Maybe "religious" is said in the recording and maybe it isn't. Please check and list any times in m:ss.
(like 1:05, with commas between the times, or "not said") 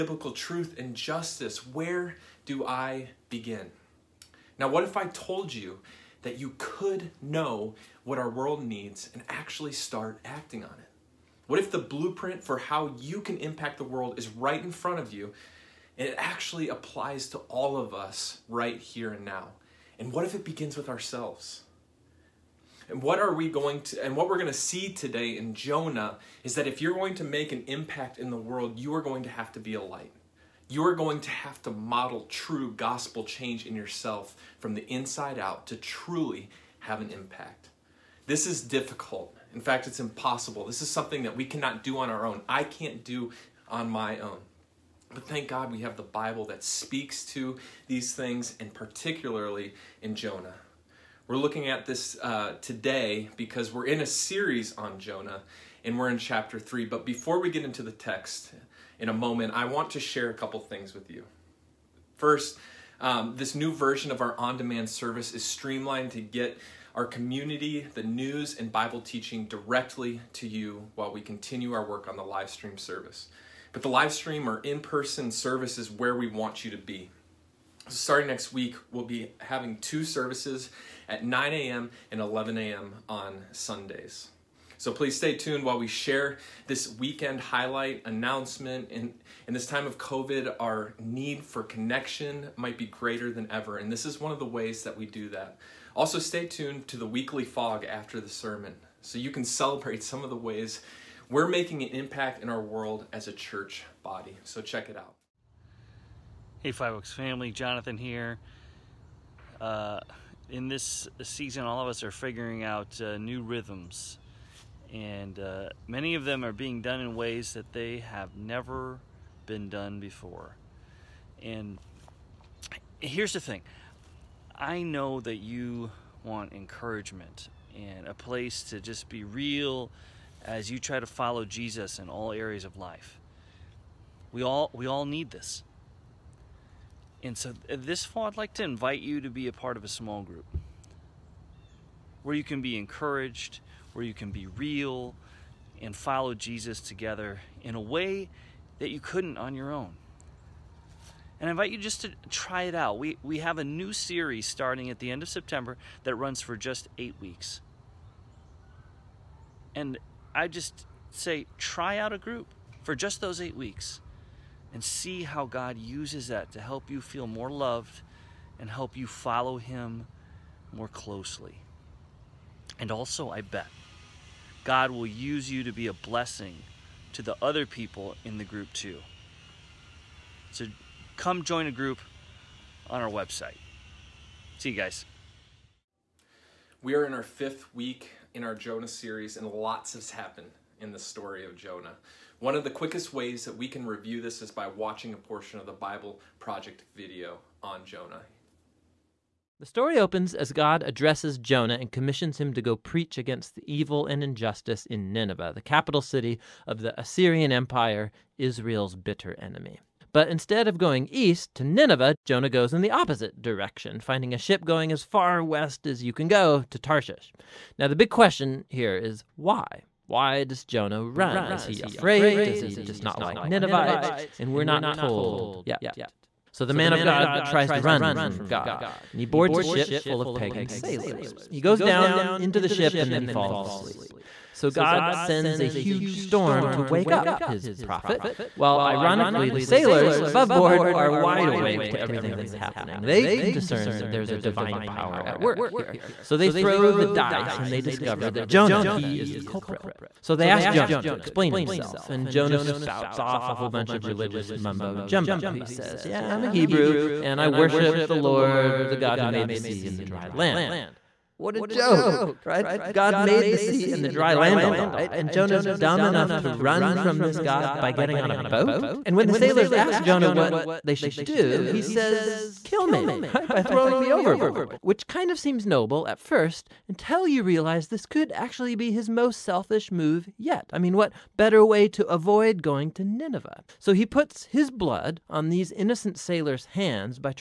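4:14.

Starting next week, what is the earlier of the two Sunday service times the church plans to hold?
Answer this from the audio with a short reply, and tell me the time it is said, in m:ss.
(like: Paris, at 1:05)
9 a.m., at 1:21.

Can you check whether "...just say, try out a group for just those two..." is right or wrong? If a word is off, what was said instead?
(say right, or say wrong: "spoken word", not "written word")
wrong: "eight", not "two".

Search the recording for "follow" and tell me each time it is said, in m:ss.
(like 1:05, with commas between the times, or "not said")
2:11, 2:25, 2:49.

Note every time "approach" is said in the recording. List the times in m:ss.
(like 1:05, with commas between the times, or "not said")
not said.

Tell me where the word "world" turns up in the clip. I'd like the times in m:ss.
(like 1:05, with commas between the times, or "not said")
0:08, 0:13, 0:28, 1:42.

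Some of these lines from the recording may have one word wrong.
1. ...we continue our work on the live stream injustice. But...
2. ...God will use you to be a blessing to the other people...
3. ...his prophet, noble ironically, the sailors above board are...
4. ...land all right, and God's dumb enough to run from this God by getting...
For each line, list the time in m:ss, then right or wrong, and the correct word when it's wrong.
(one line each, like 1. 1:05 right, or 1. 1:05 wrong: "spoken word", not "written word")
1. 1:11 wrong: "service", not "injustice"
2. 2:54 right
3. 3:57 wrong: "while", not "noble"
4. 4:24 wrong: "Jonah", not "God".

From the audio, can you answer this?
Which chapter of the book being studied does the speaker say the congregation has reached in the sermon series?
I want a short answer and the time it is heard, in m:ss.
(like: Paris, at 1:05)
Chapter 3, at 0:56.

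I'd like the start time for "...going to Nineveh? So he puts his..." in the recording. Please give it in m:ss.
4:42.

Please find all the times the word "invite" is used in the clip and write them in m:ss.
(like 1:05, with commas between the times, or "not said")
2:18, 2:31.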